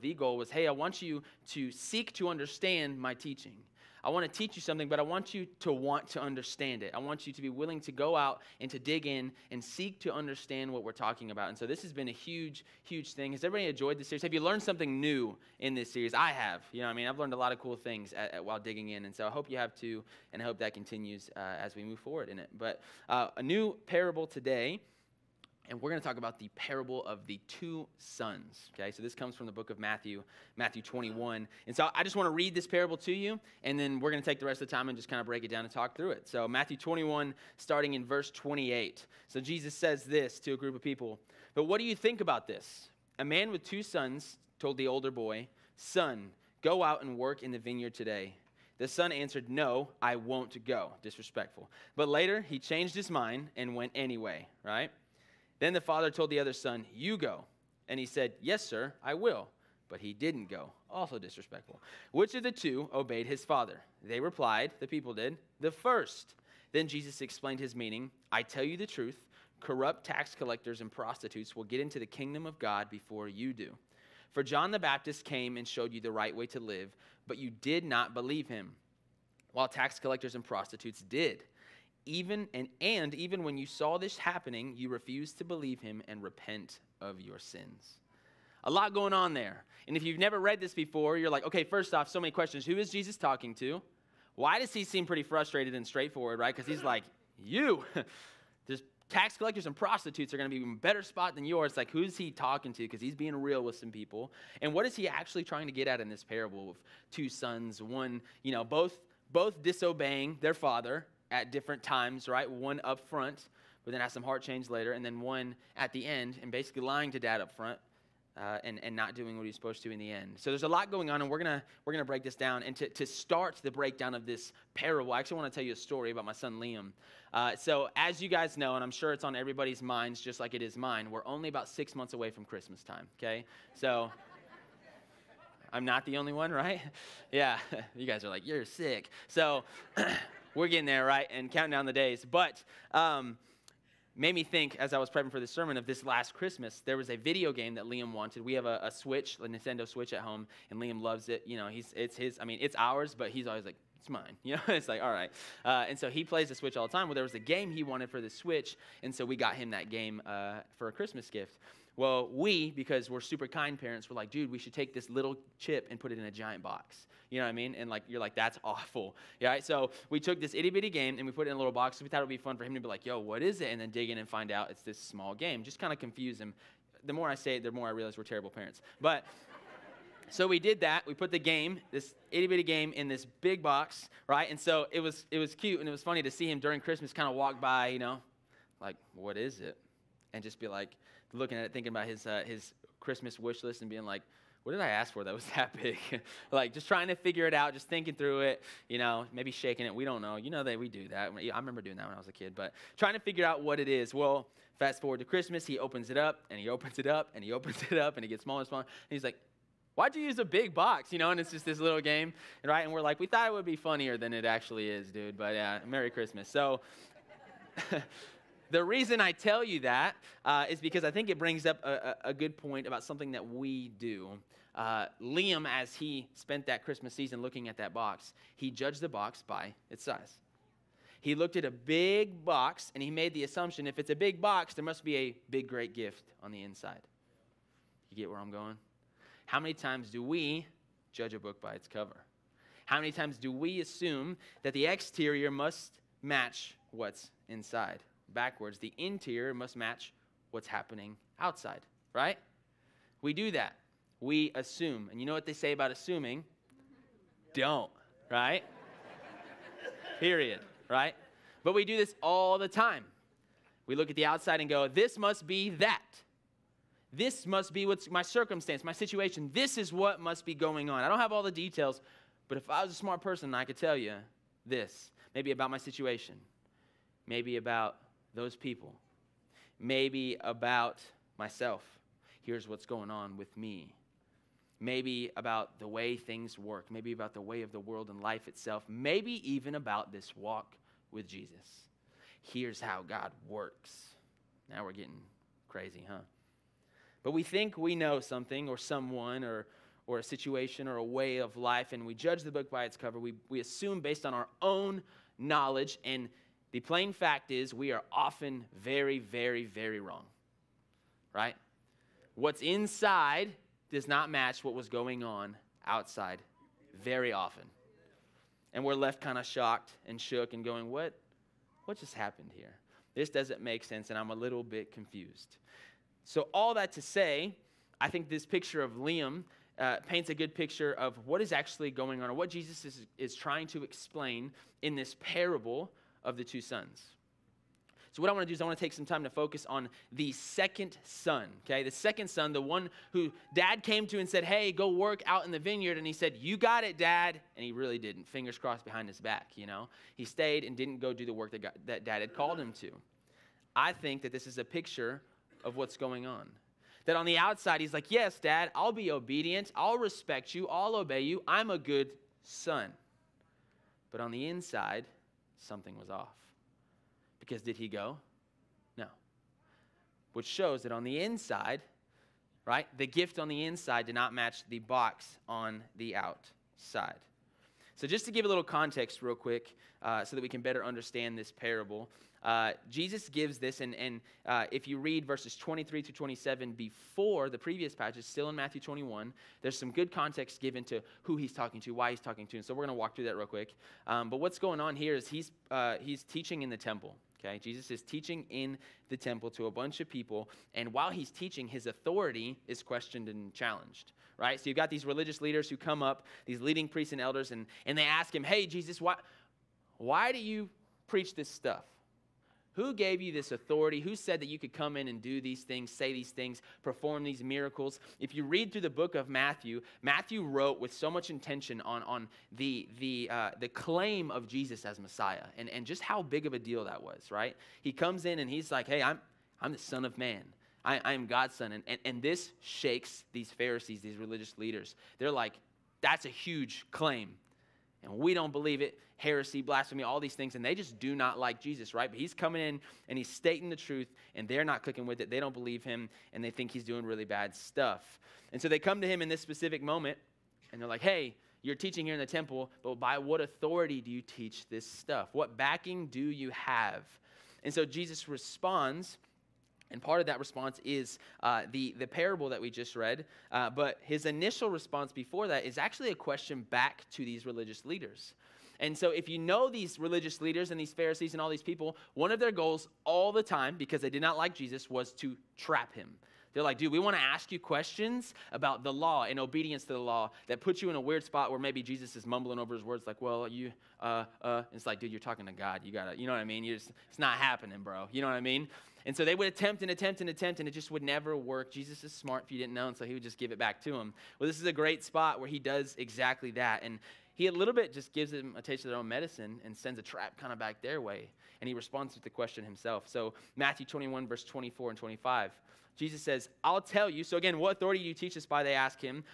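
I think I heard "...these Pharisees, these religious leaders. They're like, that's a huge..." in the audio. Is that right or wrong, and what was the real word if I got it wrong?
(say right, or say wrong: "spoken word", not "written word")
right.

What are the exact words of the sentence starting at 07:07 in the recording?
He comes in and he's like, hey, I'm, I'm the Son of Man.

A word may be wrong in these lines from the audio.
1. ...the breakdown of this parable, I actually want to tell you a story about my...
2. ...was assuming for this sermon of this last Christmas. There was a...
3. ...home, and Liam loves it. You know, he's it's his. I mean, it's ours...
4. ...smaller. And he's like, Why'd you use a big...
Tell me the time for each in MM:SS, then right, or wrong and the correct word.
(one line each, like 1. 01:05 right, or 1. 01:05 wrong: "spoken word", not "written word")
1. 02:03 right
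2. 02:24 wrong: "prepping", not "assuming"
3. 02:30 right
4. 03:28 right.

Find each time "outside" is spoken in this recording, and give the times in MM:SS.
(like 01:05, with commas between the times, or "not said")
04:11, 04:24, 05:15, 05:57, 06:16.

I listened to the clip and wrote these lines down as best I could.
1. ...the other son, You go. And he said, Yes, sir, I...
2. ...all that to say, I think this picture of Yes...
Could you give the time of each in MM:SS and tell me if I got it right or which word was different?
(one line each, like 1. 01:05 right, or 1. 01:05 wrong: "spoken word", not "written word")
1. 00:56 right
2. 05:26 wrong: "Liam", not "Yes".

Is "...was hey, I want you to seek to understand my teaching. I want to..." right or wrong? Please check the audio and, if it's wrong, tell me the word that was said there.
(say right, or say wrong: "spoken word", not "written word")
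right.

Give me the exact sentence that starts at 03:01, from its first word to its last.
We put the game, this itty bitty game, in this big box, right?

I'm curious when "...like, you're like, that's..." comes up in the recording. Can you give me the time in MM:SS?
02:47.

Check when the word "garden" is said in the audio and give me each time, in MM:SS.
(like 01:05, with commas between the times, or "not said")
not said.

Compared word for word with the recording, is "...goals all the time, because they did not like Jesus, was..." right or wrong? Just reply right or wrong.
right.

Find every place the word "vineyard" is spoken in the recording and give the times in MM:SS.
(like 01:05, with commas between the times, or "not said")
00:47, 05:45.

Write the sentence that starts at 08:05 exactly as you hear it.
You gotta, you know what I mean?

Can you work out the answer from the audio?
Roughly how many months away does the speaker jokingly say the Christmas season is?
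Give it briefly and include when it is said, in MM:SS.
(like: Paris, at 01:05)
6, at 02:11.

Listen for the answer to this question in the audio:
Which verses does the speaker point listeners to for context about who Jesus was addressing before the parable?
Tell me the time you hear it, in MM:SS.
06:25.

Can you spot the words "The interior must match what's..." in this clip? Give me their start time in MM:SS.
04:08.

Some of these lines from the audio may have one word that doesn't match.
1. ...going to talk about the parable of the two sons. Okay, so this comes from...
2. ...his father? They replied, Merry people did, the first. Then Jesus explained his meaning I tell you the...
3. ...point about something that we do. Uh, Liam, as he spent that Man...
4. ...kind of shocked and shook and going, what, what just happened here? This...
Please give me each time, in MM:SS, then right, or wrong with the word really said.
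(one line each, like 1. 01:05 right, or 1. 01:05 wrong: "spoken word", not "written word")
1. 00:25 right
2. 01:03 wrong: "The", not "Merry"
3. 03:42 wrong: "Christmas", not "Man"
4. 05:19 right.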